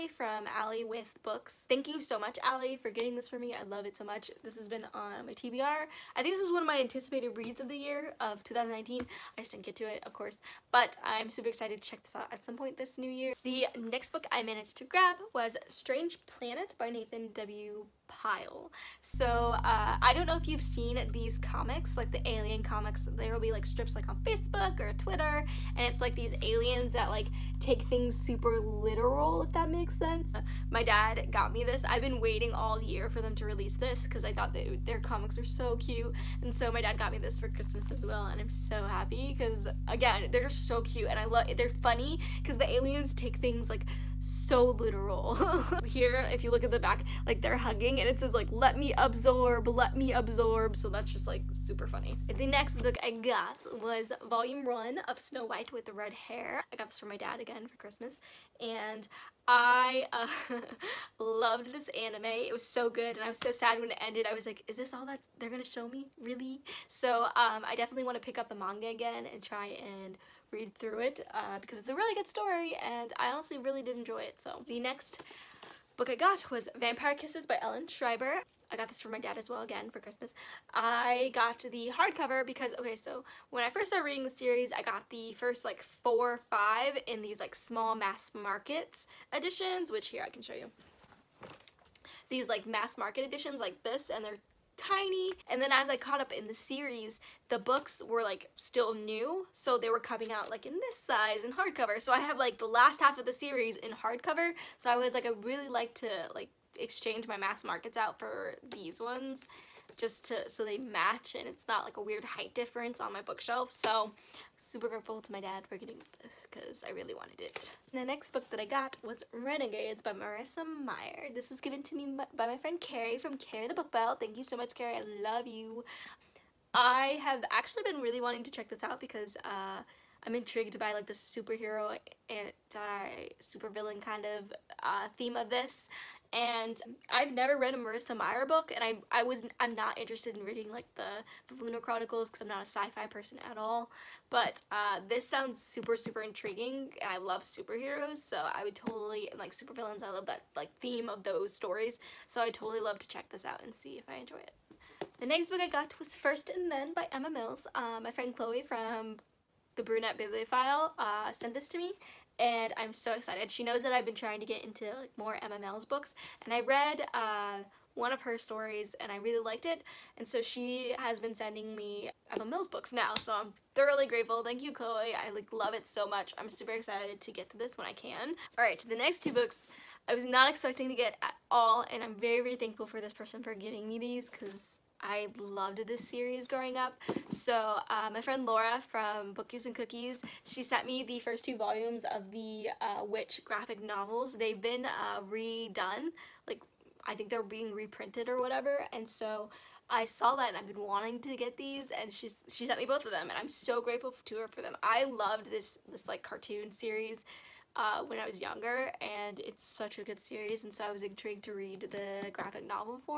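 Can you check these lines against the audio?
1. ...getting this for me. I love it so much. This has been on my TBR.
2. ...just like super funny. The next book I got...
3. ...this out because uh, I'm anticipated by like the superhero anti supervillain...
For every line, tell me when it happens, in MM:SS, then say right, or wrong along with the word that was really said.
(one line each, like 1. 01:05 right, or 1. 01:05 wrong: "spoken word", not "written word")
1. 00:02 right
2. 00:51 right
3. 02:08 wrong: "intrigued", not "anticipated".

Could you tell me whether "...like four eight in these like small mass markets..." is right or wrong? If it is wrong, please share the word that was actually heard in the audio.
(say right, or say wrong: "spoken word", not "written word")
wrong: "five", not "eight".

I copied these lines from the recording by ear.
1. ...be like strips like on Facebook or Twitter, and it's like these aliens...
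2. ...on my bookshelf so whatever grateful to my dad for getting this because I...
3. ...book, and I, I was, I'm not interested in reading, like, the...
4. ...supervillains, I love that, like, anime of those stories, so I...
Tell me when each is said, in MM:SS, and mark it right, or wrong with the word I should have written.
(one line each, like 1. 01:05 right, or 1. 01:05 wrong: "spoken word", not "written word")
1. 00:23 right
2. 01:53 wrong: "super", not "whatever"
3. 02:18 right
4. 02:29 wrong: "theme", not "anime".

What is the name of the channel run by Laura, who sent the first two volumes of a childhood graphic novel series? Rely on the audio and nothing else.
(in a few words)
Bookies and Cookies.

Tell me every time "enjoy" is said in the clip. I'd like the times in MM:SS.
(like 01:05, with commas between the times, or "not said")
01:13, 02:34.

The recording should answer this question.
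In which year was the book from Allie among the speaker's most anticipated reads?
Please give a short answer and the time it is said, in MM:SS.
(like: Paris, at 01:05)
2019, at 00:08.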